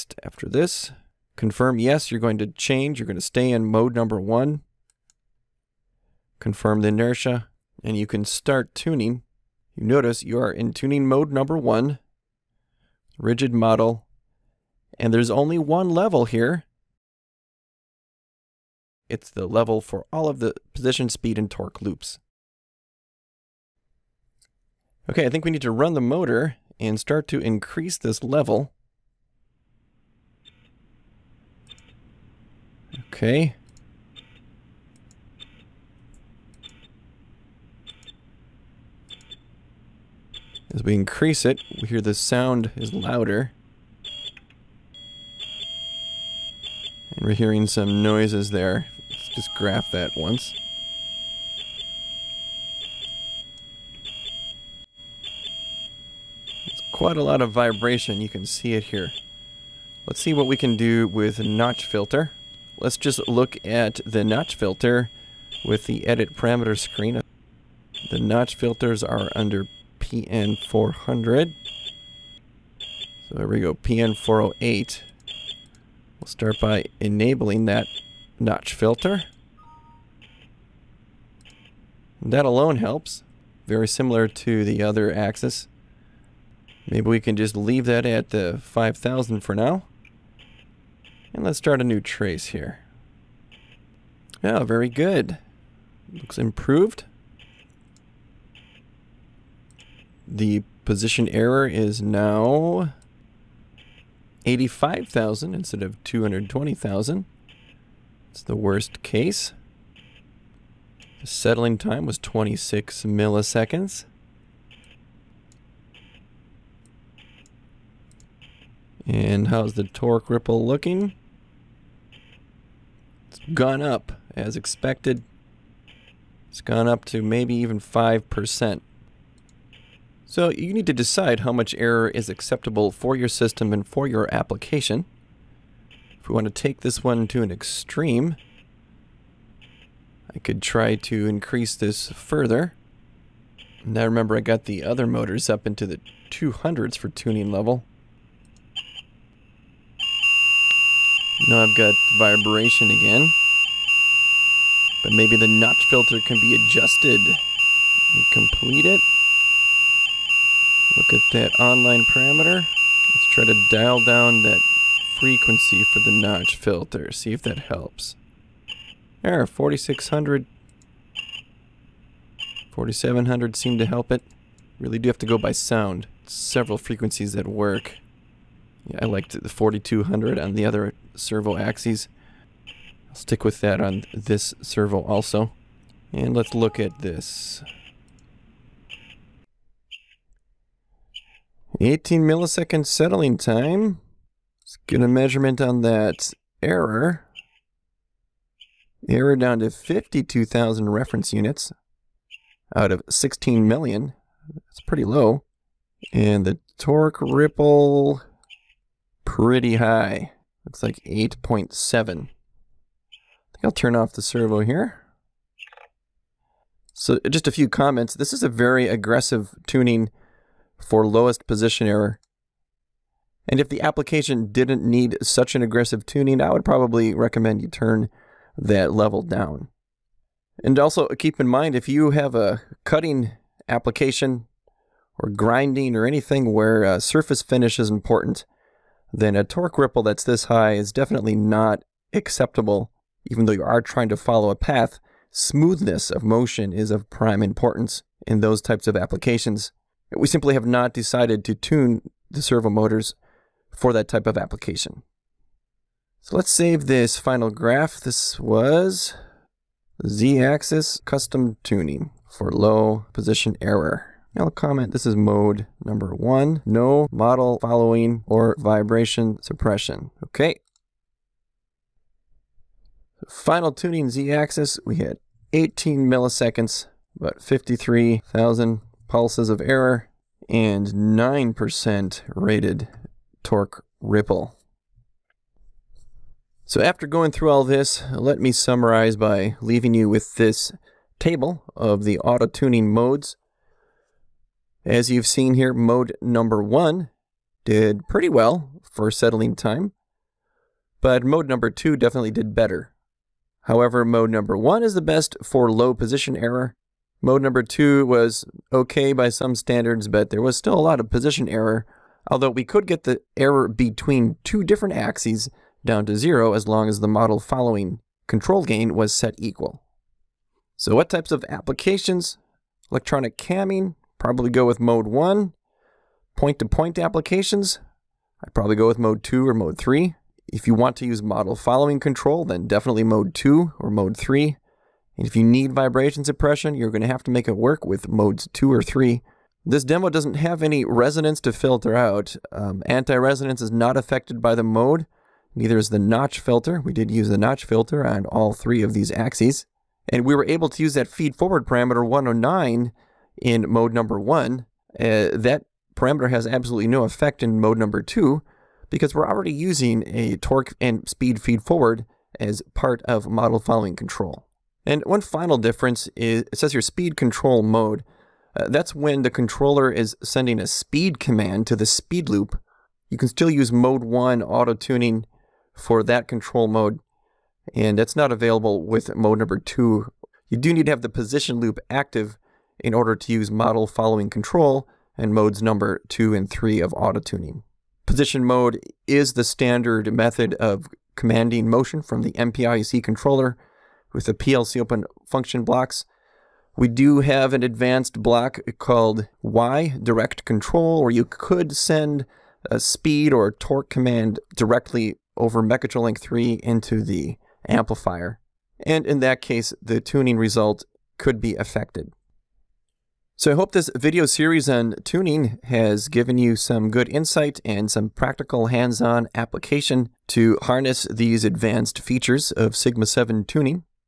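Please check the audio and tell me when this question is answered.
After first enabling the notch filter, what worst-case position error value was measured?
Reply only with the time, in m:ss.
1:44.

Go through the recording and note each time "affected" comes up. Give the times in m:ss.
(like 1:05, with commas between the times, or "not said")
5:43, 6:51.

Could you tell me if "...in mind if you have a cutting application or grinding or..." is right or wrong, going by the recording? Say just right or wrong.
right.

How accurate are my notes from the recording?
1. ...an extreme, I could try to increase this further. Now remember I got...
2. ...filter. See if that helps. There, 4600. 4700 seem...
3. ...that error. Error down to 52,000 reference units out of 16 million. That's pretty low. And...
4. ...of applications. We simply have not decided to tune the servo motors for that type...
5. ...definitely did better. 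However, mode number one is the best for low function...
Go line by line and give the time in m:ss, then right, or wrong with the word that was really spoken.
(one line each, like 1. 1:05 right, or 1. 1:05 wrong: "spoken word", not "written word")
1. 2:17 right
2. 2:46 right
3. 3:15 right
4. 4:08 right
5. 5:01 wrong: "position", not "function".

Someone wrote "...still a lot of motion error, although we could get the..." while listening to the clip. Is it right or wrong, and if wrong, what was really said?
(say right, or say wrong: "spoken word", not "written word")
wrong: "position", not "motion".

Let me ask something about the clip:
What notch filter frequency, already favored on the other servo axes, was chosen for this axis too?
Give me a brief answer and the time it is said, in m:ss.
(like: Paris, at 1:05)
4200, at 2:59.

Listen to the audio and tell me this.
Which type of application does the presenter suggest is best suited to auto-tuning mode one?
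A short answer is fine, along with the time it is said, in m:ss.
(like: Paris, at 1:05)
Electronic camming, at 5:22.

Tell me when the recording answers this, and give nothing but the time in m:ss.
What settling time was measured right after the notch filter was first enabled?
1:52.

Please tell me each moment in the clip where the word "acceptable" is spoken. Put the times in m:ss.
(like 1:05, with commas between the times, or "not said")
2:12, 4:02.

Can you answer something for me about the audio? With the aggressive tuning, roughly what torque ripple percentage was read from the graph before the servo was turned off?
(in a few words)
8.7.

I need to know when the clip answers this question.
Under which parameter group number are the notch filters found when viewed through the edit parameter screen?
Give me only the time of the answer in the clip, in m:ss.
1:10.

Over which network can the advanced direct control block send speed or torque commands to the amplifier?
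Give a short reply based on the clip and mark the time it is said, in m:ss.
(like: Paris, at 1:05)
Mechatrolink 3, at 6:45.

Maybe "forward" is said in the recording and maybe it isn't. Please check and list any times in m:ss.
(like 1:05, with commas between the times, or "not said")
5:51, 6:01.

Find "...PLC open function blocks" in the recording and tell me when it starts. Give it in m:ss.
6:34.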